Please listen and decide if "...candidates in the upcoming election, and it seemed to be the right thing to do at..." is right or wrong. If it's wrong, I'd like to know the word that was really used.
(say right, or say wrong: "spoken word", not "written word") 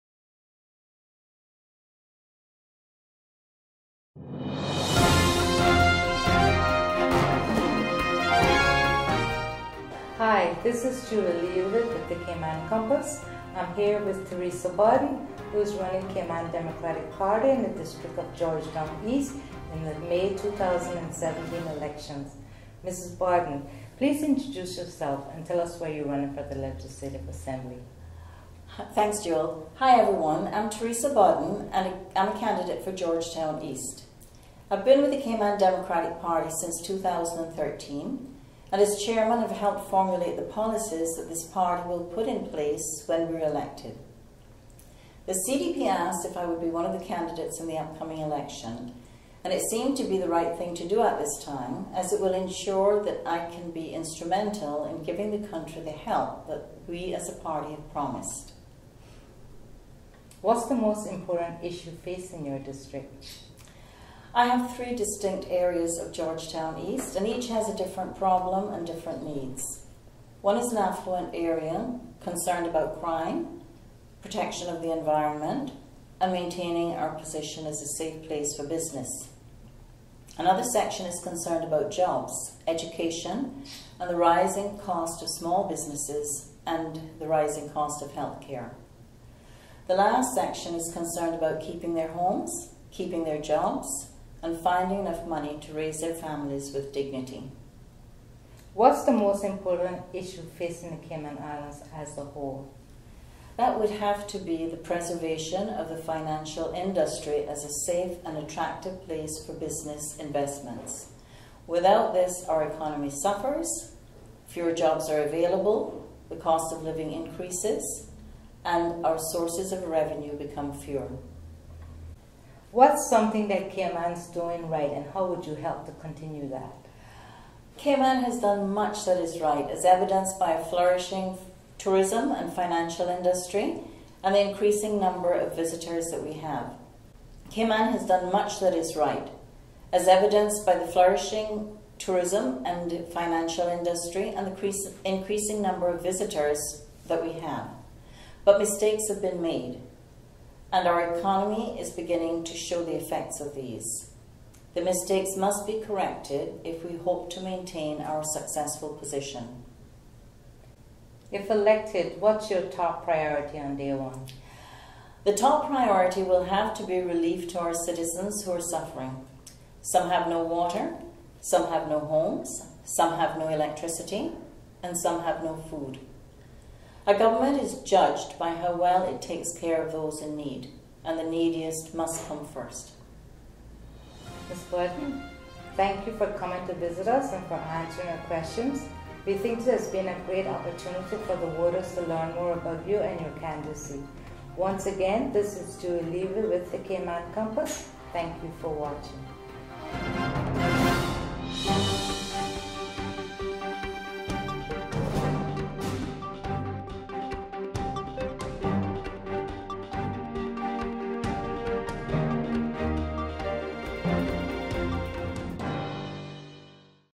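right.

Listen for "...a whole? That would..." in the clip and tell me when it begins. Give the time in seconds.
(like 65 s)
102 s.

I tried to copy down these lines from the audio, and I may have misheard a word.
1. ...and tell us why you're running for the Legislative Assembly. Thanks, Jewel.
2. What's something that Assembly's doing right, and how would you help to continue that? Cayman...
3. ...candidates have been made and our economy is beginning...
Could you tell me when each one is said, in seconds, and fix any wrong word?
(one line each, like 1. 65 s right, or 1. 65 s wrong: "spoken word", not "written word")
1. 25 s right
2. 122 s wrong: "Cayman", not "Assembly"
3. 148 s wrong: "mistakes", not "candidates".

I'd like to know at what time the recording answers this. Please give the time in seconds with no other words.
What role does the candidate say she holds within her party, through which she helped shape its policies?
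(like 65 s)
39 s.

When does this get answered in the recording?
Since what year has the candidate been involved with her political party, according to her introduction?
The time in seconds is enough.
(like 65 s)
36 s.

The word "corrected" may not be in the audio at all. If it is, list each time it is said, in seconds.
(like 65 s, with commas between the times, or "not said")
155 s.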